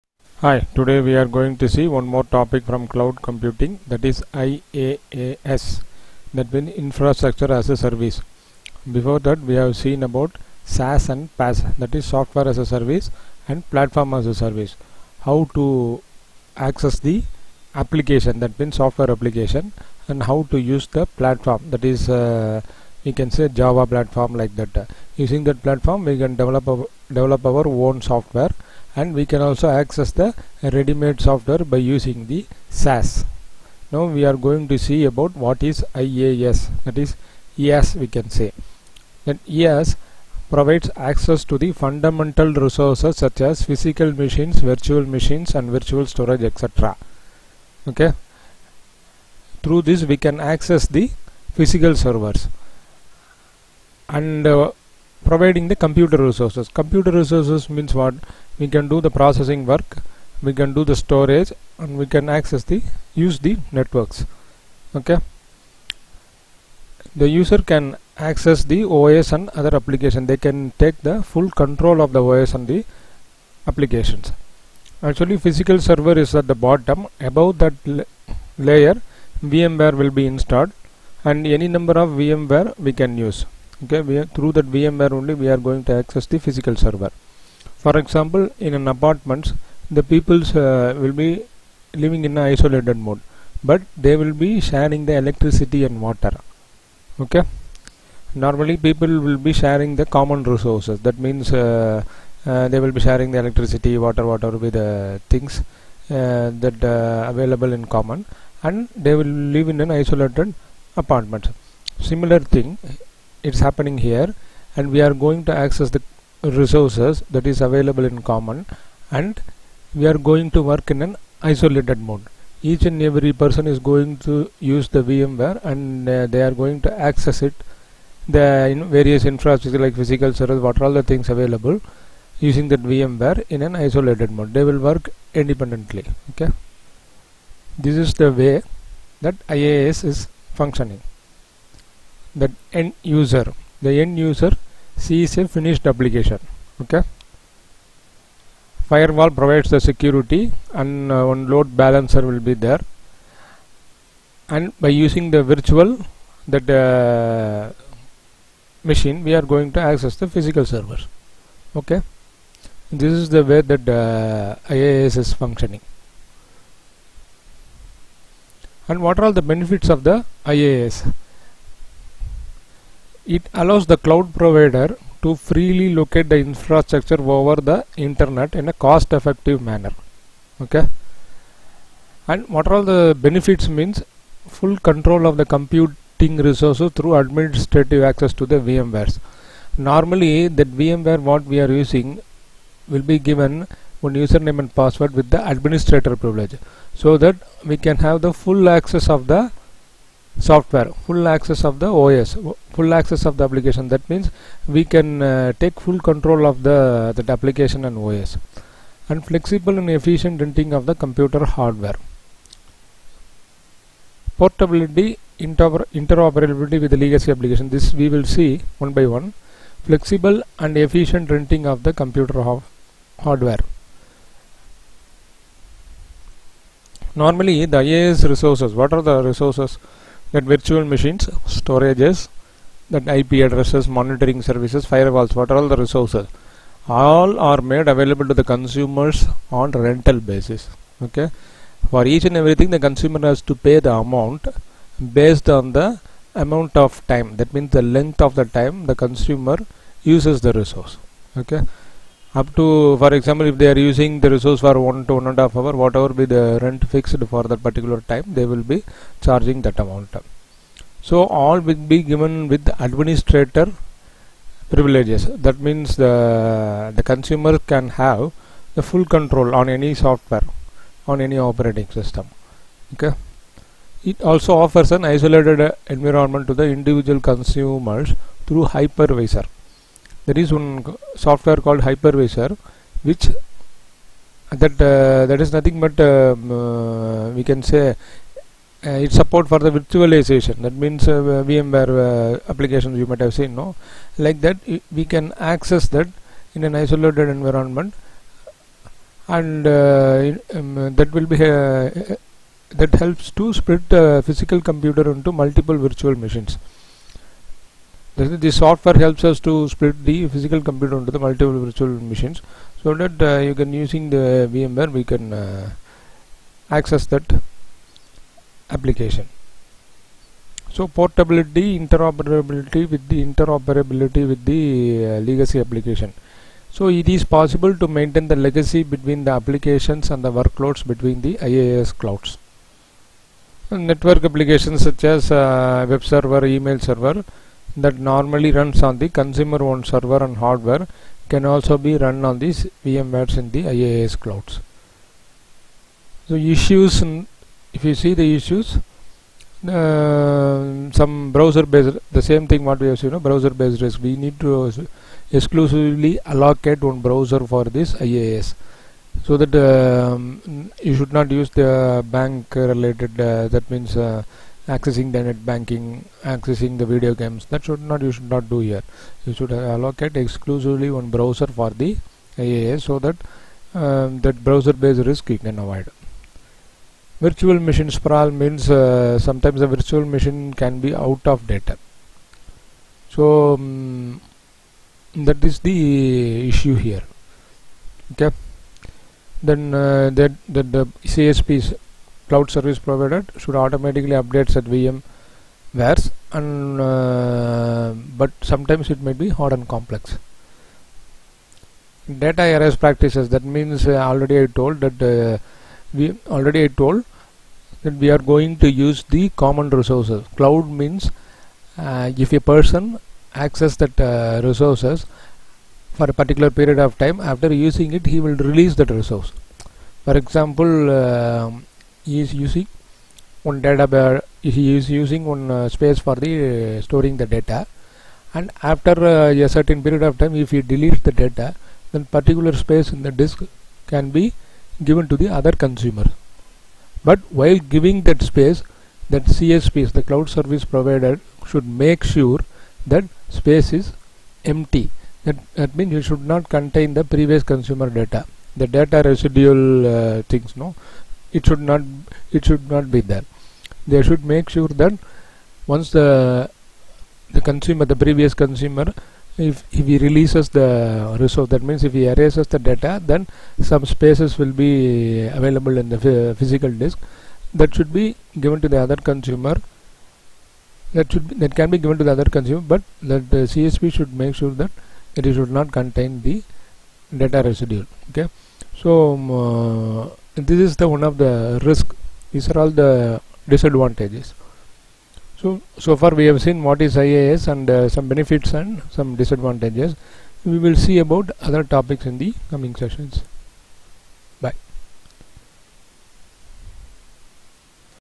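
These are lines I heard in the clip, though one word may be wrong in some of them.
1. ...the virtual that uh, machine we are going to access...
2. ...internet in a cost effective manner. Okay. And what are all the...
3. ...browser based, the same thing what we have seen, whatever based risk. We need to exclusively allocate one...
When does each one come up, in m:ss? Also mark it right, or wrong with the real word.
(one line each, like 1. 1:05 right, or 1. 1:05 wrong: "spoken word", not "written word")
1. 2:35 right
2. 2:57 right
3. 5:51 wrong: "browser", not "whatever".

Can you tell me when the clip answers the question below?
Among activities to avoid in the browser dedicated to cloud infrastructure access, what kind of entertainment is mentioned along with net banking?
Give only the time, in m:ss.
6:06.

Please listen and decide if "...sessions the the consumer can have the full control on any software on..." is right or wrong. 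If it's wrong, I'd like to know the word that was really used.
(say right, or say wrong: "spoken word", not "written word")
wrong: "means", not "sessions".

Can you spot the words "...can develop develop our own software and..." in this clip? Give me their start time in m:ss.
0:26.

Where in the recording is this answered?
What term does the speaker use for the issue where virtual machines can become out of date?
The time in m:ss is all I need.
6:17.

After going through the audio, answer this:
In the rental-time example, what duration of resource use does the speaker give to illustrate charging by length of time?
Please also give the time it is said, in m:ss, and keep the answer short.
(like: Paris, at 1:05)
one and a half hour, at 4:15.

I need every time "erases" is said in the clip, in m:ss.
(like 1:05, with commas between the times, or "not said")
7:42.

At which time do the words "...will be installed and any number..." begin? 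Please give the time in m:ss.
1:20.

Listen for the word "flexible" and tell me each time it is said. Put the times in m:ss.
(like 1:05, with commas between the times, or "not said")
3:29, 3:39.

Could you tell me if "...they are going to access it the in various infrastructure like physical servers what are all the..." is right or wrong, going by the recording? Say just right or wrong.
right.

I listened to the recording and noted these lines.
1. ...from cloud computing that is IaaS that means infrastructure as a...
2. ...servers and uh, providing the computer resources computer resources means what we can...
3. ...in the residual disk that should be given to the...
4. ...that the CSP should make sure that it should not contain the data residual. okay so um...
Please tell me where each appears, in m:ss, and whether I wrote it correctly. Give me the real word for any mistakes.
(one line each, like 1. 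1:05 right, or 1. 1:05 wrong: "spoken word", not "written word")
1. 0:02 right
2. 0:51 right
3. 7:45 wrong: "physical", not "residual"
4. 7:53 right.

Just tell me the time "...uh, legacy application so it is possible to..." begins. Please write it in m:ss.
5:25.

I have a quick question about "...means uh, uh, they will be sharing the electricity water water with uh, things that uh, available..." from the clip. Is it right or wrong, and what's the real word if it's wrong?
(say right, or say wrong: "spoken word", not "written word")
right.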